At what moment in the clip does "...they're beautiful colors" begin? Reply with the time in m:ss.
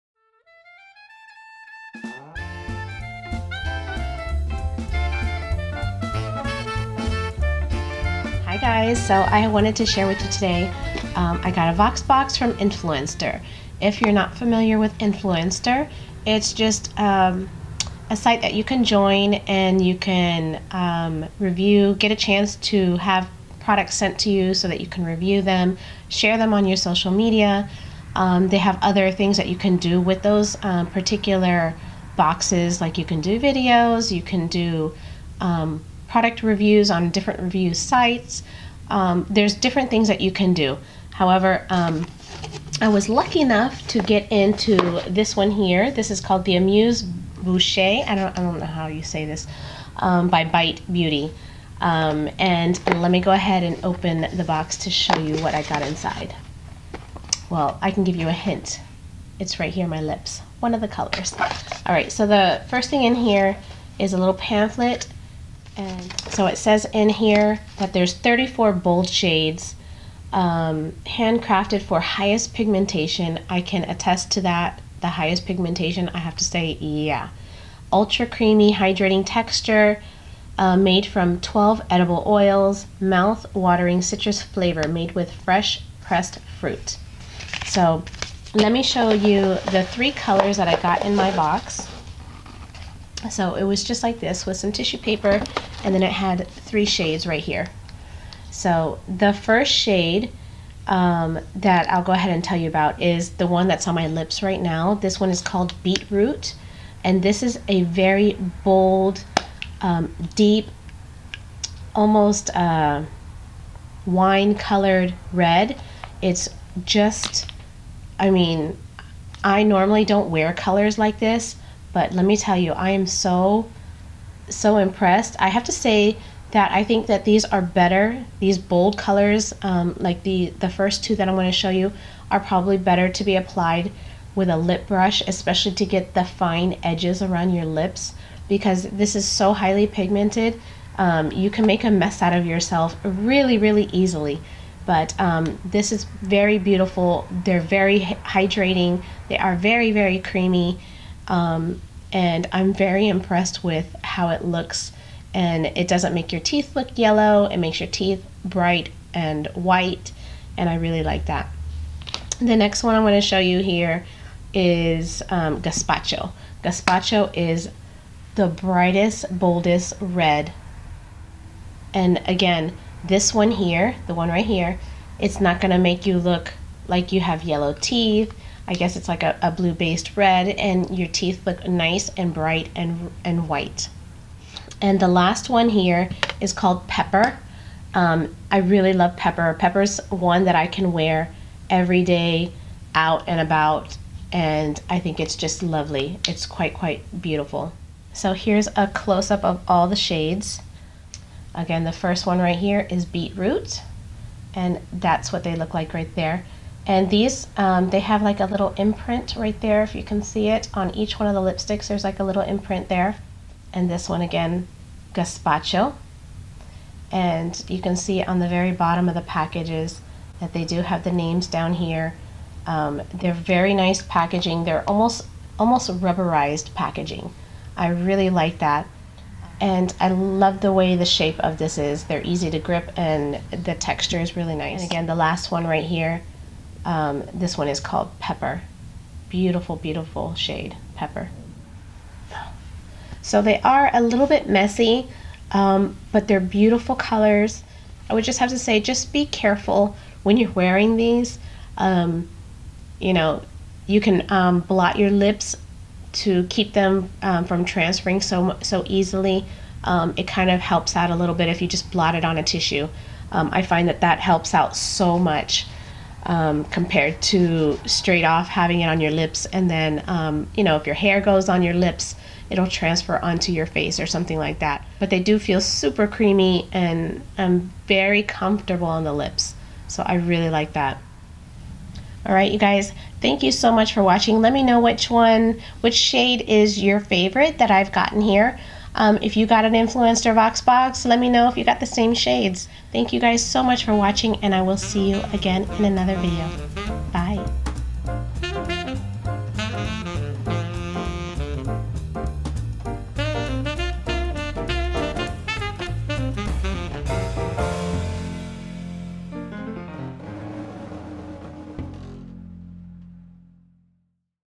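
4:06.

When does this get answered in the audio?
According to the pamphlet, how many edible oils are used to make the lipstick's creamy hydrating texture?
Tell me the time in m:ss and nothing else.
1:21.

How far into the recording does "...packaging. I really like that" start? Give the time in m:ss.
3:46.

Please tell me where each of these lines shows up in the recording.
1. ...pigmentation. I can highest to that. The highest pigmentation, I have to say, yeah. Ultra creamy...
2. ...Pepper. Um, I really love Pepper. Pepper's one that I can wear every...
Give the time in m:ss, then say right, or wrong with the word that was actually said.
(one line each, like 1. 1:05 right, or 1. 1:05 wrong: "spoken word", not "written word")
1. 1:12 wrong: "attest", not "highest"
2. 3:06 right.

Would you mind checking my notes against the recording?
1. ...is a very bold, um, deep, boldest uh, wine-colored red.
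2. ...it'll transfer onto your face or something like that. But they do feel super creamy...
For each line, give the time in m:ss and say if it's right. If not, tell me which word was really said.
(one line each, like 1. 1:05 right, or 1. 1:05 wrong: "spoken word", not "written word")
1. 1:47 wrong: "almost", not "boldest"
2. 4:32 right.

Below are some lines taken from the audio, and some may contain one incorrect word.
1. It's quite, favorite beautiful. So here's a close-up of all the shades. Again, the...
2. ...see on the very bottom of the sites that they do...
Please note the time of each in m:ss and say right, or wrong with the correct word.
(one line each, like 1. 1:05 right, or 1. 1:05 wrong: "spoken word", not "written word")
1. 3:16 wrong: "quite", not "favorite"
2. 3:37 wrong: "packages", not "sites".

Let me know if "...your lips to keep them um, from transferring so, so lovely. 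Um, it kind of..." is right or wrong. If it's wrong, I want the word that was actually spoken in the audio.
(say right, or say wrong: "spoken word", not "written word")
wrong: "easily", not "lovely".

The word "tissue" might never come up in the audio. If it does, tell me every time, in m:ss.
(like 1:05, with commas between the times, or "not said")
1:34, 4:22.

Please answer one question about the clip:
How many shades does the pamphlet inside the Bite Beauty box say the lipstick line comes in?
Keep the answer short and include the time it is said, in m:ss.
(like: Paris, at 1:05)
34, at 1:08.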